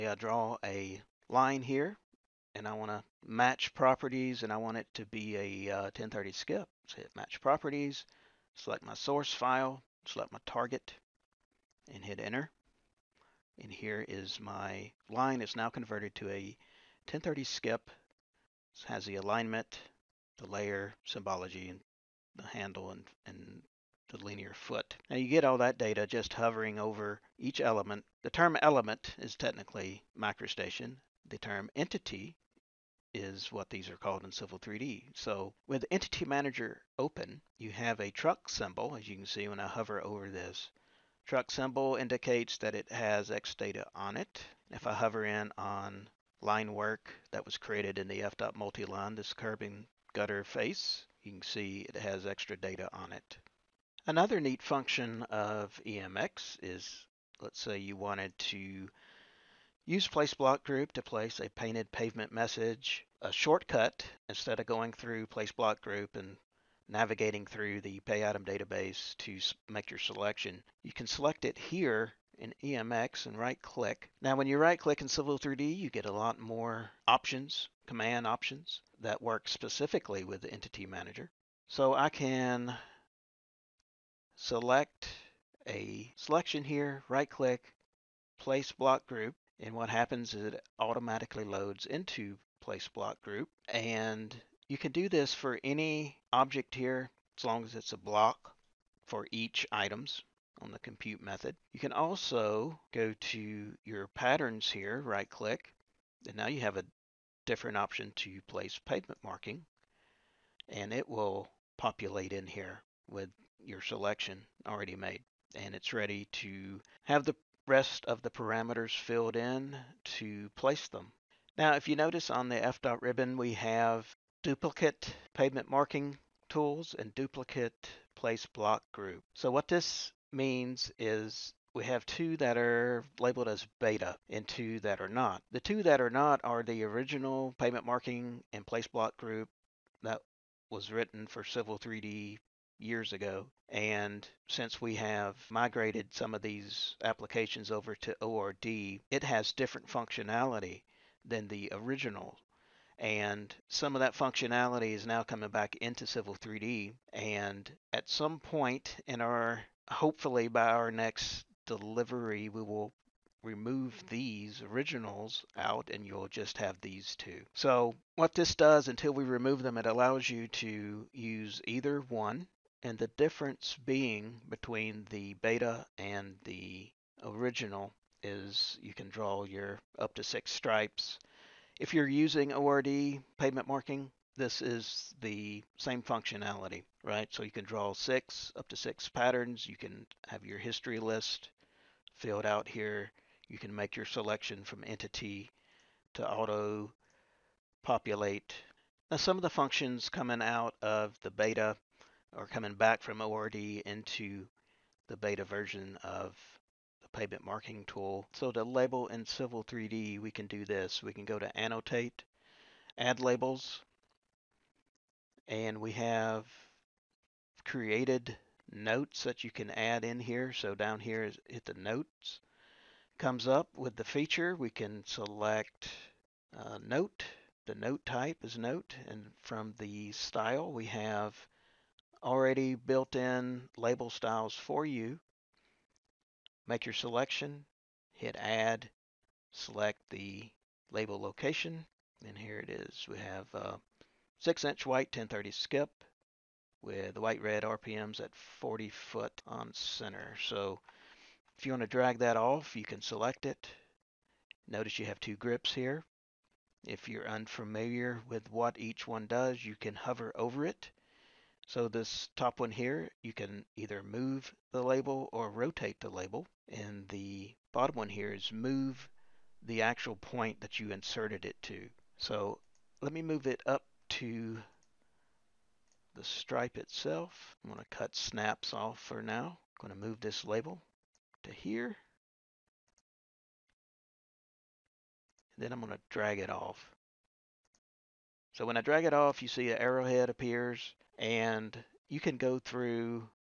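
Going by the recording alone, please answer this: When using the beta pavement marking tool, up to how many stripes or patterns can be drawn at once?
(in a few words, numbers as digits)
6.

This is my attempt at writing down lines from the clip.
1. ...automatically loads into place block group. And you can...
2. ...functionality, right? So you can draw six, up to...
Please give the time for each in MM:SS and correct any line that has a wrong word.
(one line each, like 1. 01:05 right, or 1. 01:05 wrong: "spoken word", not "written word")
1. 01:30 right
2. 03:06 right.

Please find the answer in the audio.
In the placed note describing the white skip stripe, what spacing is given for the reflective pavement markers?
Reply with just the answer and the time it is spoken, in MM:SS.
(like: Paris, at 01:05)
40 foot on center, at 04:08.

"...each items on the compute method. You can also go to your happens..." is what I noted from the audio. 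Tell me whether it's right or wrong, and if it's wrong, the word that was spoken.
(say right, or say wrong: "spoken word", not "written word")
wrong: "patterns", not "happens".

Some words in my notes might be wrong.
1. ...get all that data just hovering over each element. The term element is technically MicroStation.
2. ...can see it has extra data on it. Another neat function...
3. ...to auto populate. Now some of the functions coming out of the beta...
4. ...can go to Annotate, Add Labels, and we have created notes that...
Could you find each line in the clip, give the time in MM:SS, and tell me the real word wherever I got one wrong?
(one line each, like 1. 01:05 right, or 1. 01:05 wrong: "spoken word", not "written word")
1. 00:25 right
2. 00:51 right
3. 03:16 right
4. 03:31 right.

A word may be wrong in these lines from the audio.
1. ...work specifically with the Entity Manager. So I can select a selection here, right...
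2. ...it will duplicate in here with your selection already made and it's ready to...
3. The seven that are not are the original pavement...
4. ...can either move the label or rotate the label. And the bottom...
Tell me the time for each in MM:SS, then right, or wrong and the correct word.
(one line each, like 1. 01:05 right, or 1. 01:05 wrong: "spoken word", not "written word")
1. 01:19 right
2. 01:50 wrong: "populate", not "duplicate"
3. 02:15 wrong: "two", not "seven"
4. 04:23 right.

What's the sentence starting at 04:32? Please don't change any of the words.
So let me move it up to the stripe itself.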